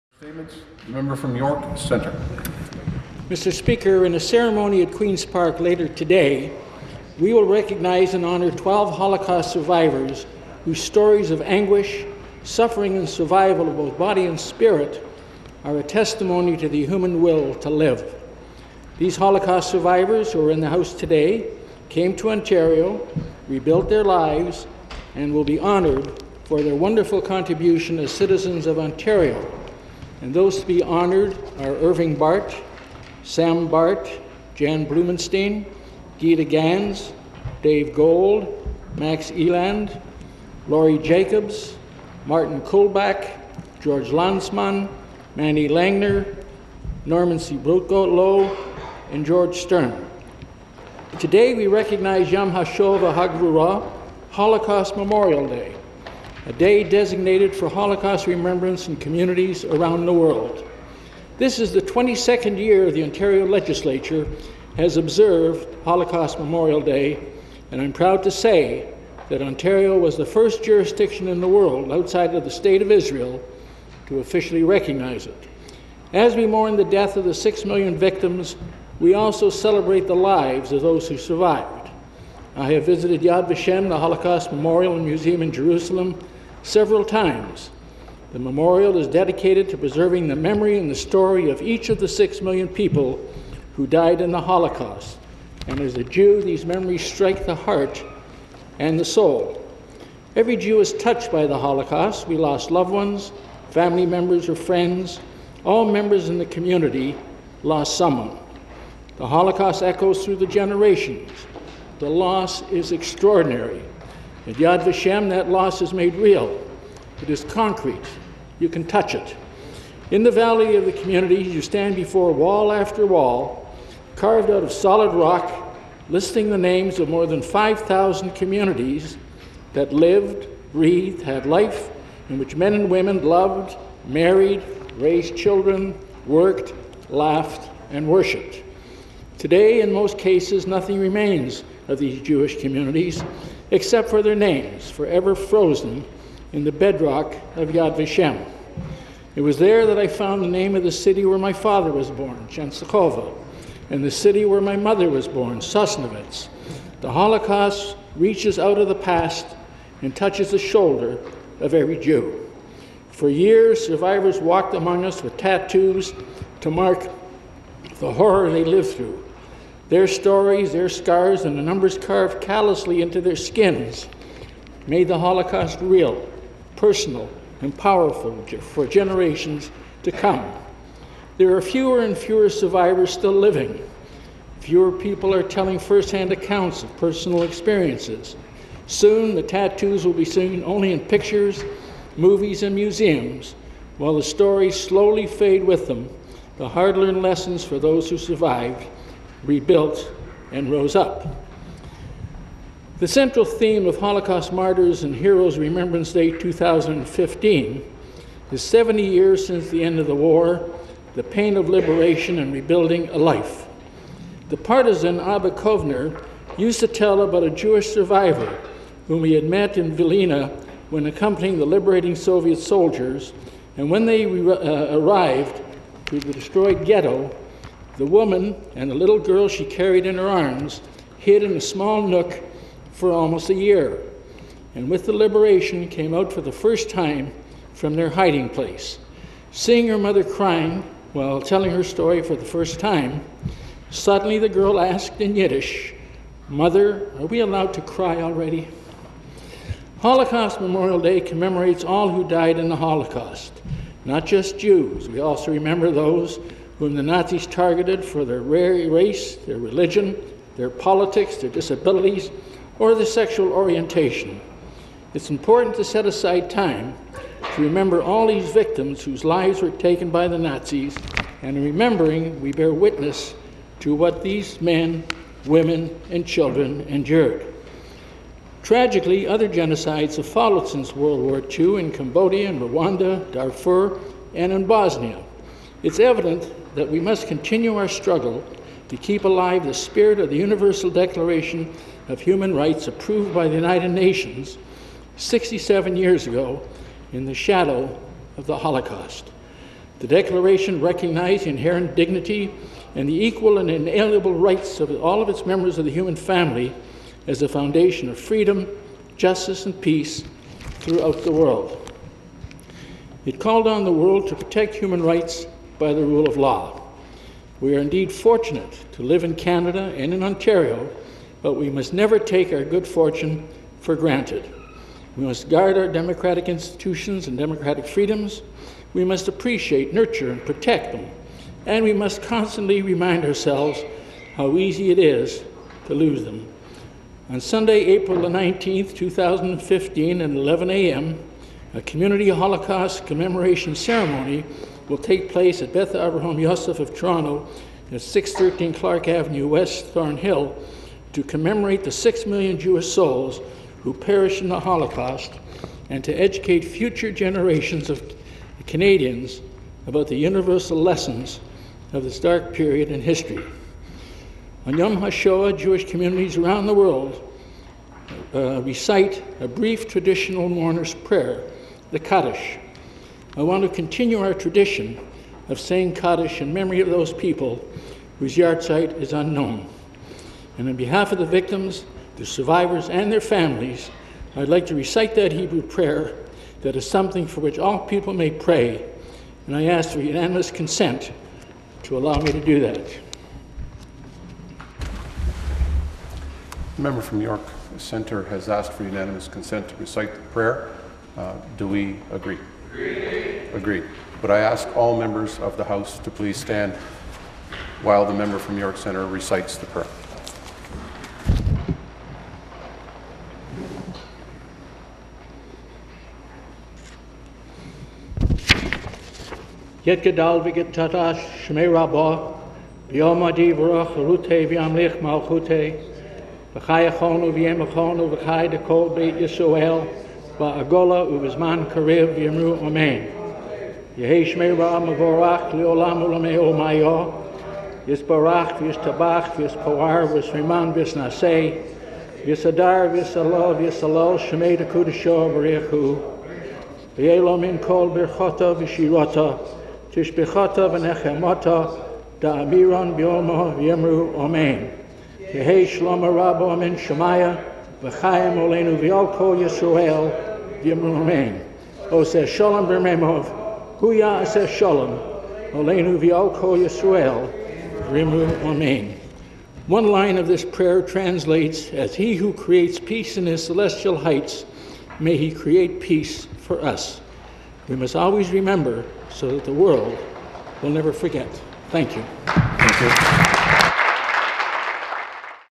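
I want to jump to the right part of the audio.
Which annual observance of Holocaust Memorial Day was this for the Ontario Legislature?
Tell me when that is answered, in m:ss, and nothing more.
1:01.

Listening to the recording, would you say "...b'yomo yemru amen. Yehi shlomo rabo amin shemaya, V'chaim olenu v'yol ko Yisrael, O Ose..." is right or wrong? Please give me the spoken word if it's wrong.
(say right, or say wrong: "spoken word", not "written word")
right.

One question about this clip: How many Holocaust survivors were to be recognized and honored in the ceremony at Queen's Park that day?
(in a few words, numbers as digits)
12.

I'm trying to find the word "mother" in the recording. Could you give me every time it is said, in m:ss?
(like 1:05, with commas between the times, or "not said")
2:34, 3:59, 4:06.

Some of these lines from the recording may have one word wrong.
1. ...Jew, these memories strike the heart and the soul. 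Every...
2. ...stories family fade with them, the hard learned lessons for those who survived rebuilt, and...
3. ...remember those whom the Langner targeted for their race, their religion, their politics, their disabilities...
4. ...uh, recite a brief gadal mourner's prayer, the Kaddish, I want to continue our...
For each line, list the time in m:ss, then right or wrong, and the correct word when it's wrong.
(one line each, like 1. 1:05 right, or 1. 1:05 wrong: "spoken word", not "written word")
1. 1:36 right
2. 3:14 wrong: "slowly", not "family"
3. 4:15 wrong: "Nazis", not "Langner"
4. 6:08 wrong: "traditional", not "gadal".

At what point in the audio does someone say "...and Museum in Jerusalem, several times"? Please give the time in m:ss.
1:24.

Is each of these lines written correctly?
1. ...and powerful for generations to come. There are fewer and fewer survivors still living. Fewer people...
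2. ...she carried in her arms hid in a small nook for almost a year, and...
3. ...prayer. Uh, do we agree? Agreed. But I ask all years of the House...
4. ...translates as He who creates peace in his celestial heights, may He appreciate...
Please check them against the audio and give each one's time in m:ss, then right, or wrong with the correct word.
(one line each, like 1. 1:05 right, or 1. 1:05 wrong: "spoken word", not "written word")
1. 2:57 right
2. 3:49 right
3. 6:40 wrong: "members", not "years"
4. 7:50 wrong: "create", not "appreciate".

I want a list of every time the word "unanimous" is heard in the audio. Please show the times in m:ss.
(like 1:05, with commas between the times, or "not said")
6:30, 6:38.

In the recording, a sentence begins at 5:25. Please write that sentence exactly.
We must guard our democratic institutions and democratic freedoms.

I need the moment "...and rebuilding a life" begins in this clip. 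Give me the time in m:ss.
3:32.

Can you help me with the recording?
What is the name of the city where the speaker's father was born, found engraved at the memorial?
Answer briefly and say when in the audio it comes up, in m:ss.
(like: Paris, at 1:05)
Częstochowa, at 2:32.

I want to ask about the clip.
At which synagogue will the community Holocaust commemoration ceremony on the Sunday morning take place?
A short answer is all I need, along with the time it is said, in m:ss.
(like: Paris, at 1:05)
Beth Avraham Yosef of Toronto, at 5:45.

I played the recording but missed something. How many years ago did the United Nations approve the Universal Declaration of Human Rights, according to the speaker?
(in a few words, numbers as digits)
67.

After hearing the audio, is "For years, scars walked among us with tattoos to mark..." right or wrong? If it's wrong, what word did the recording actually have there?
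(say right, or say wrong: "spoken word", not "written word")
wrong: "survivors", not "scars".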